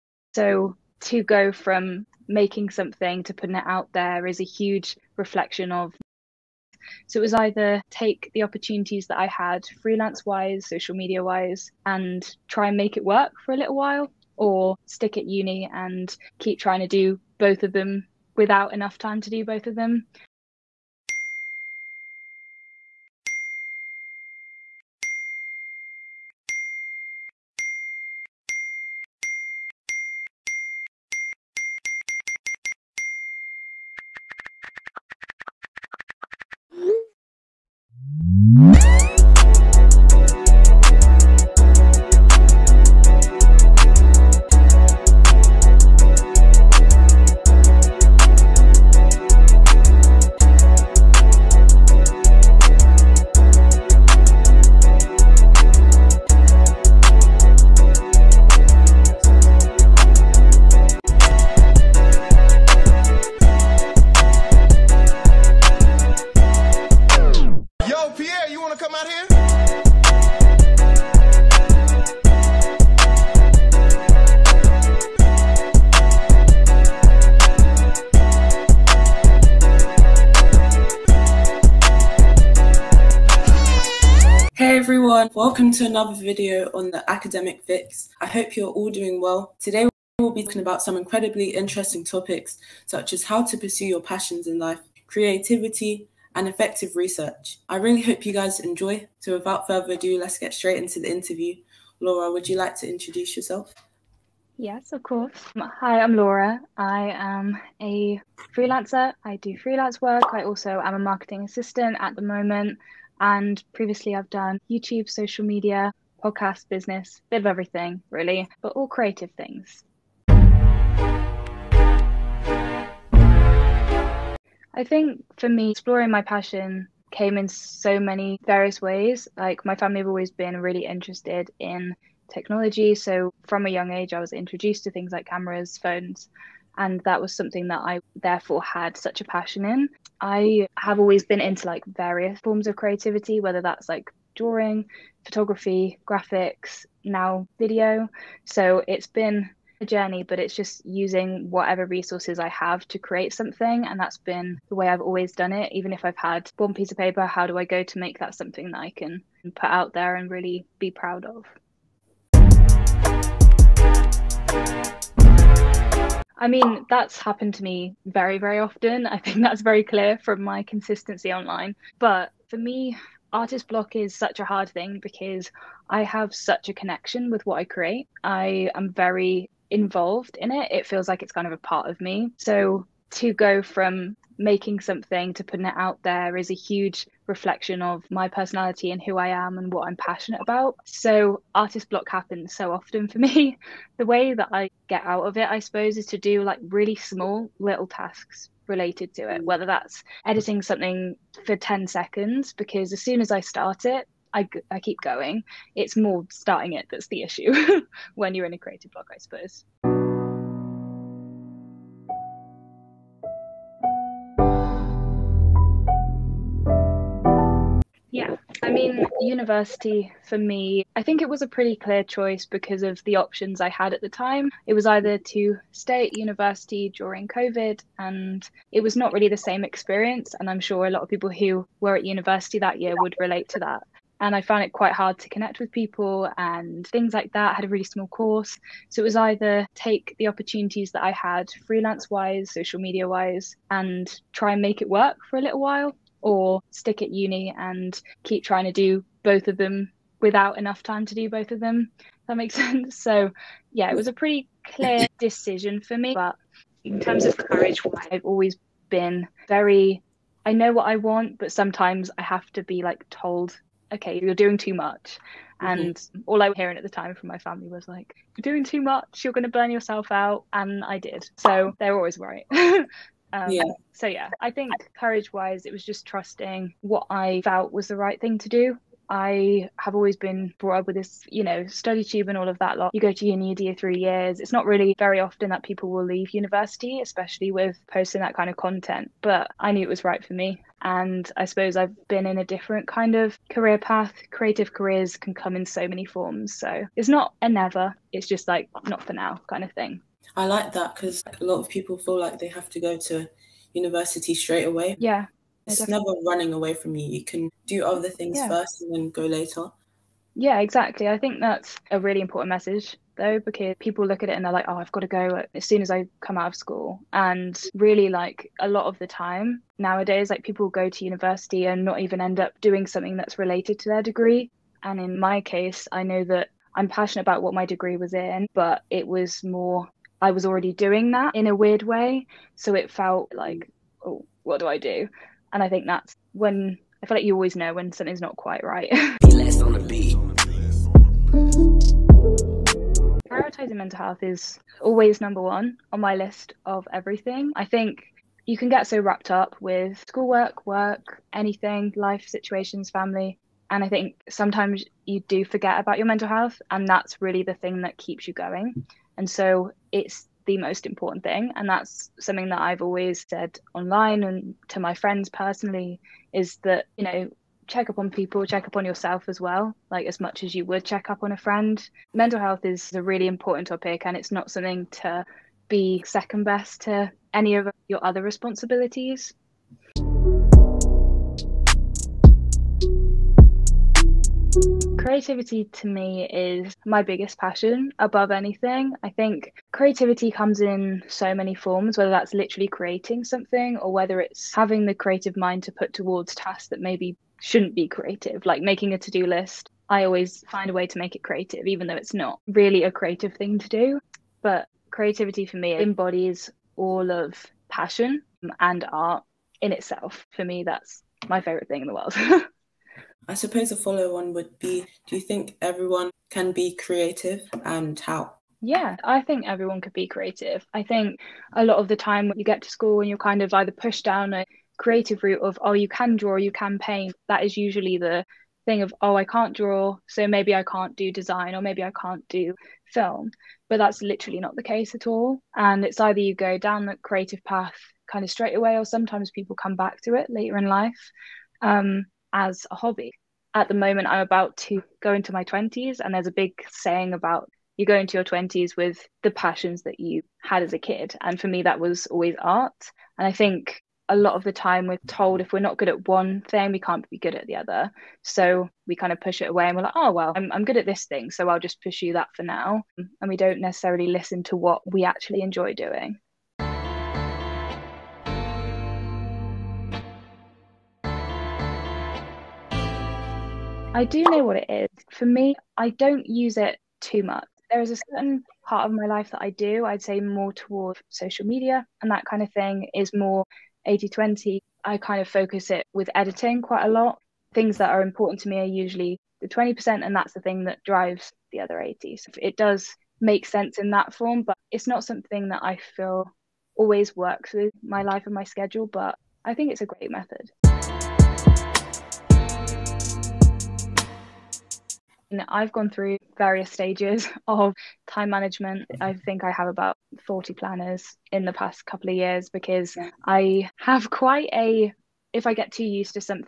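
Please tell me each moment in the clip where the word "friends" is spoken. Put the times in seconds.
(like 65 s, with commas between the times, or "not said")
364 s, 371 s.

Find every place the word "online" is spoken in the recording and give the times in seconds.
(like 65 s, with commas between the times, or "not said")
171 s, 363 s.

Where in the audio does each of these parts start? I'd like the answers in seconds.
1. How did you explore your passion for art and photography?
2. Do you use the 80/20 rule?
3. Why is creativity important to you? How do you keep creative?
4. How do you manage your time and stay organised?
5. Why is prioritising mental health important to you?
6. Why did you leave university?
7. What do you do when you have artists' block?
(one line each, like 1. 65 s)
1. 120 s
2. 467 s
3. 380 s
4. 501 s
5. 339 s
6. 210 s
7. 162 s.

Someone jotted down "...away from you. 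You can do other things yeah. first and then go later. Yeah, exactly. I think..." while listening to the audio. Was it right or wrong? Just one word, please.
right.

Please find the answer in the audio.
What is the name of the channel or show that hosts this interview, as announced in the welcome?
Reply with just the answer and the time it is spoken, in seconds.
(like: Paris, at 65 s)
Academic Fix, at 87 s.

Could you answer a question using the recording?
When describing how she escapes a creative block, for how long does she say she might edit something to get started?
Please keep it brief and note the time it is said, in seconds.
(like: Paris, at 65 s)
10 seconds, at 201 s.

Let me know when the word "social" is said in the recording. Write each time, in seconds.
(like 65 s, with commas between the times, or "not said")
10 s, 115 s, 242 s, 481 s.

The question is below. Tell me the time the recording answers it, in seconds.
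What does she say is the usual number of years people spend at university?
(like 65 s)
283 s.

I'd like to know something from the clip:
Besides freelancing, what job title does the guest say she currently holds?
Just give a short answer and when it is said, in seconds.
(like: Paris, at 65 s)
marketing assistant, at 110 s.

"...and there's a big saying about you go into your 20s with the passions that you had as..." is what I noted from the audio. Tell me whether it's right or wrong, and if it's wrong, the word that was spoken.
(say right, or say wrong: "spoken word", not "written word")
right.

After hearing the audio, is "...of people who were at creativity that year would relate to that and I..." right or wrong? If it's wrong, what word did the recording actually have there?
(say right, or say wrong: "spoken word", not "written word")
wrong: "university", not "creativity".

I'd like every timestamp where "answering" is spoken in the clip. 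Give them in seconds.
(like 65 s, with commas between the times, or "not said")
not said.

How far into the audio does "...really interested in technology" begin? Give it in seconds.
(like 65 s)
130 s.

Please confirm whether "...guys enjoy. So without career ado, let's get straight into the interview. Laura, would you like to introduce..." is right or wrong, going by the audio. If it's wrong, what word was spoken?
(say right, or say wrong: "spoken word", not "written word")
wrong: "further", not "career".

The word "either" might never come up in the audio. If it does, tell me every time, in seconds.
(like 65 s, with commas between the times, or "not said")
7 s, 224 s, 239 s, 423 s, 436 s.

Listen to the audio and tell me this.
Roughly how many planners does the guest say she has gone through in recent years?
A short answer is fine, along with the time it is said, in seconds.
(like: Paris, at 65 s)
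40, at 510 s.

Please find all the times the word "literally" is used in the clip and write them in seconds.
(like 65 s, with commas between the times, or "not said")
392 s, 434 s.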